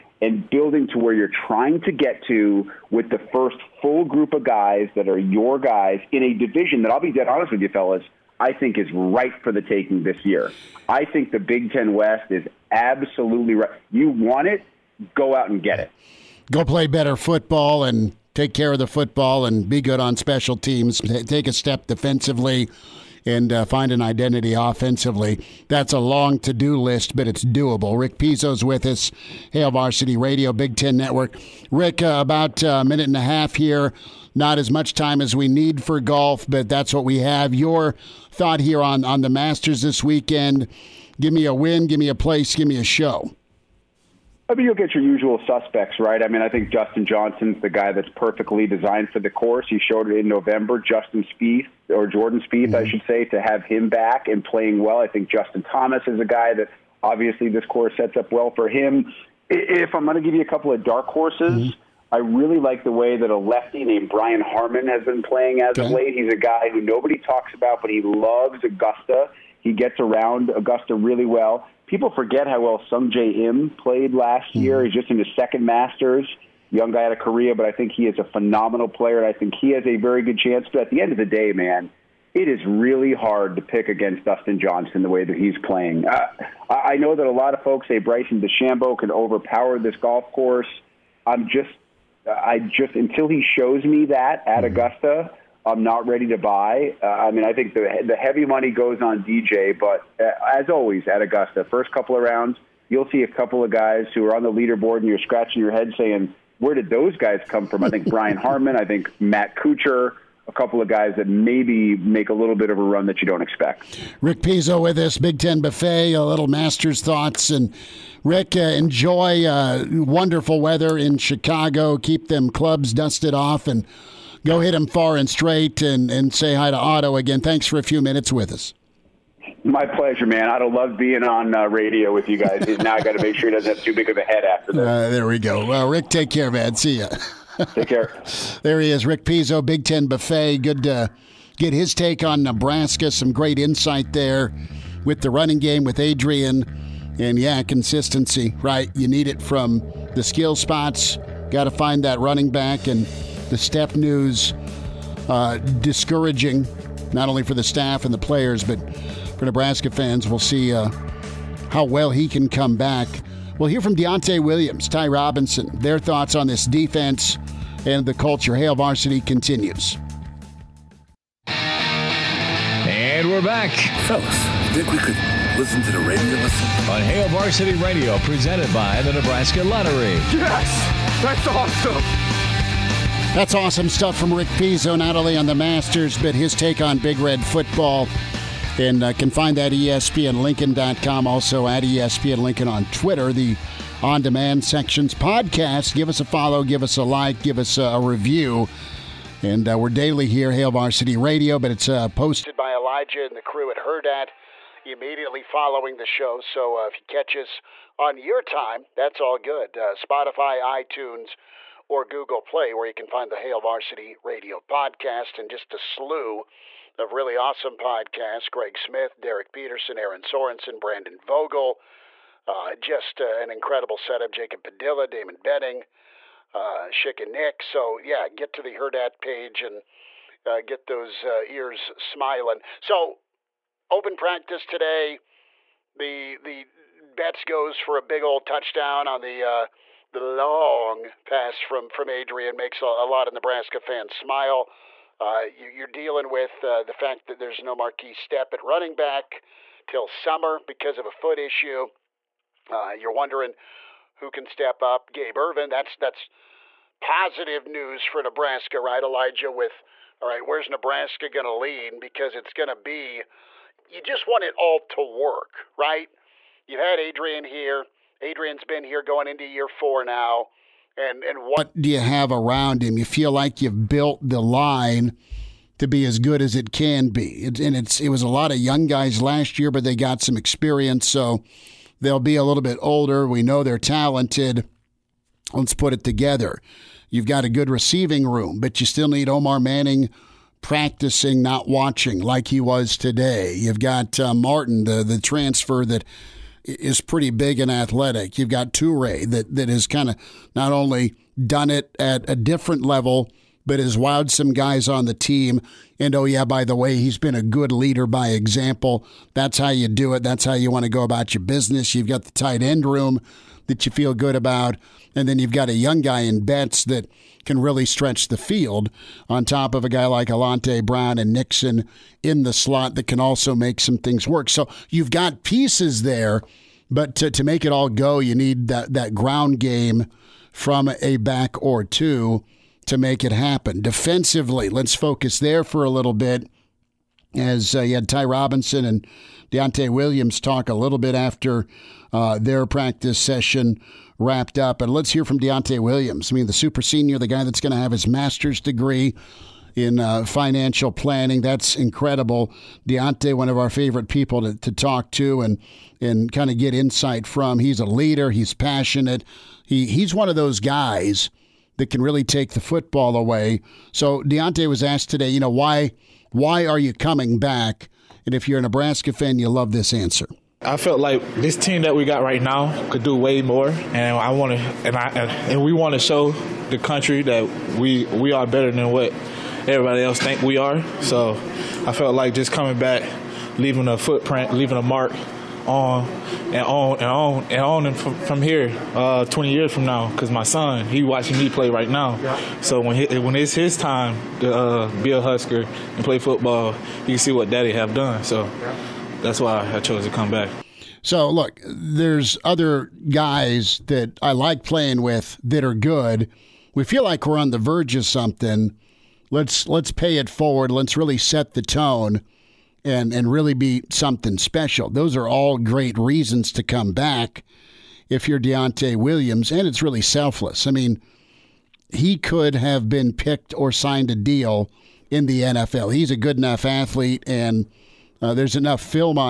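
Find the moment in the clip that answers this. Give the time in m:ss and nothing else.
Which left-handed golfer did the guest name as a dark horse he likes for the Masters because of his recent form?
1:04.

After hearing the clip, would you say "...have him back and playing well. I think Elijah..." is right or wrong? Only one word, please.
wrong.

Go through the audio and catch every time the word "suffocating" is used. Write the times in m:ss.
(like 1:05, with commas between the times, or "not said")
not said.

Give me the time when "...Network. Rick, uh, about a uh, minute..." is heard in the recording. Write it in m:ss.
0:30.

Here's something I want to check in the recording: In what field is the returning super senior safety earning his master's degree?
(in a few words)
Financial planning.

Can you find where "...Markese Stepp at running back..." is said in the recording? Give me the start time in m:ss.
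4:07.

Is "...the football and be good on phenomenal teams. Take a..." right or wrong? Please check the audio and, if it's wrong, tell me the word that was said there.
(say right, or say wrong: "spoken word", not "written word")
wrong: "special", not "phenomenal".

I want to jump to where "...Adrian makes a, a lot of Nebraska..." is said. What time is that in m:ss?
4:02.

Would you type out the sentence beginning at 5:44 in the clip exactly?
And let's hear from Deontay Williams.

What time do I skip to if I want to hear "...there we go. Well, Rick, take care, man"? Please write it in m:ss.
2:15.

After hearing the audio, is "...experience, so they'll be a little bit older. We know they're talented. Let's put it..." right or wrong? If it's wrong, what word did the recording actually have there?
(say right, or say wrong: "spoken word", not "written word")
right.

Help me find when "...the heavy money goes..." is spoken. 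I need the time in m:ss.
1:38.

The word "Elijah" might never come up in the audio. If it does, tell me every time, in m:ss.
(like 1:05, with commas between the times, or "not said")
3:22, 4:19.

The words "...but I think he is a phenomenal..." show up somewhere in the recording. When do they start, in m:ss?
1:17.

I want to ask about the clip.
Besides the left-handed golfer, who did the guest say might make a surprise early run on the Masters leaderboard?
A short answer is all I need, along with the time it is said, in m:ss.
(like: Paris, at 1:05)
Matt Kuchar, at 1:49.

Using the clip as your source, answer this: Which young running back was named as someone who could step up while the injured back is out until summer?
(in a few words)
Gabe Ervin.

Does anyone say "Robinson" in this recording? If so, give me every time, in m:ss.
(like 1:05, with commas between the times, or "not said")
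2:45, 5:38.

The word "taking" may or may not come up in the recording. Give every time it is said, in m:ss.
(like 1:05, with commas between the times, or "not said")
0:09.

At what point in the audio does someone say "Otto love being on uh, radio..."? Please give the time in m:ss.
2:10.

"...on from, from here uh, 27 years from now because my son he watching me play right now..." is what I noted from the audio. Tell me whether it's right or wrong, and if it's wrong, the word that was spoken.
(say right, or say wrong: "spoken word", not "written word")
wrong: "20", not "27".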